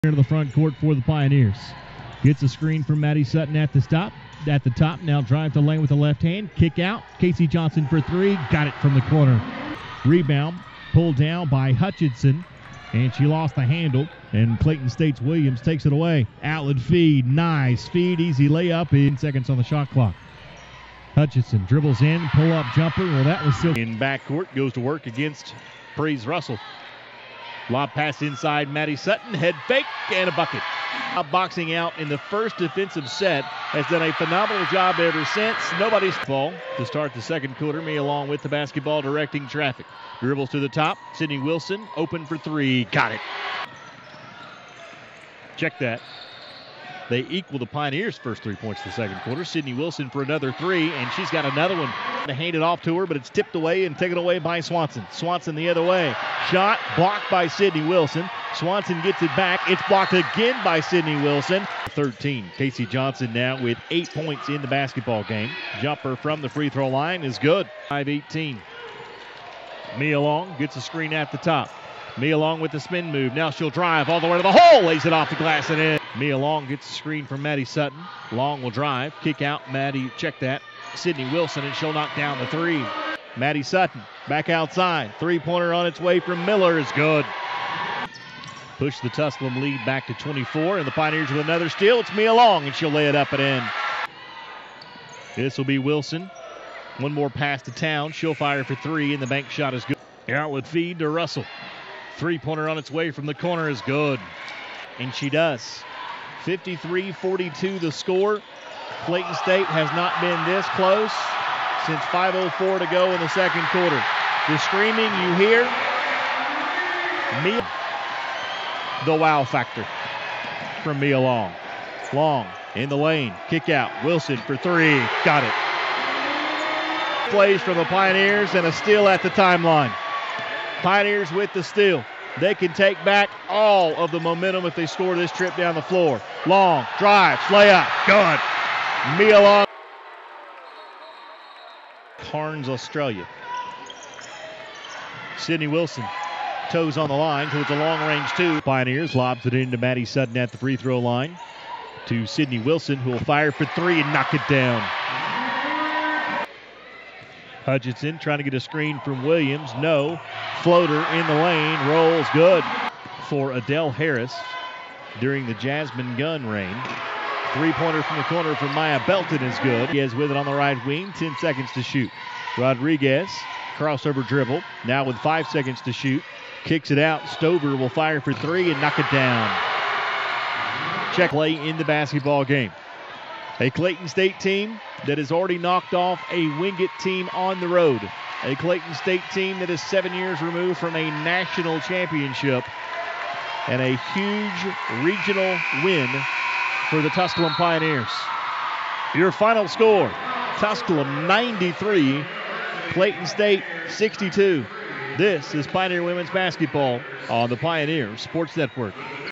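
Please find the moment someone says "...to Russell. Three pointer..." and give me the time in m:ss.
1:40.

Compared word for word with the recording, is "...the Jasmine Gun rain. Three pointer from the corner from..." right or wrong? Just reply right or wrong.
right.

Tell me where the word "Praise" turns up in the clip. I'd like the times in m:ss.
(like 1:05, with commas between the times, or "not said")
0:25.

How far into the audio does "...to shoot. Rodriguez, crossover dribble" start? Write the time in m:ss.
2:51.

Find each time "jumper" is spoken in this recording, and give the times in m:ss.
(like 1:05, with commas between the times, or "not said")
0:22, 1:05.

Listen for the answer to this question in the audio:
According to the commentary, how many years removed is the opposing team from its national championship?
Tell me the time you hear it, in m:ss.
3:09.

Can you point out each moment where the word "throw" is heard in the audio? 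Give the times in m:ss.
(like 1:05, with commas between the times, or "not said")
1:06, 2:30.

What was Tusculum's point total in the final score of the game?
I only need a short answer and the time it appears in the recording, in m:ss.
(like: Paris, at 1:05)
93, at 3:20.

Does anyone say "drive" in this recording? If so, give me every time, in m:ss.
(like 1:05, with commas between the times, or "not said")
0:05, 1:13, 1:18, 2:16.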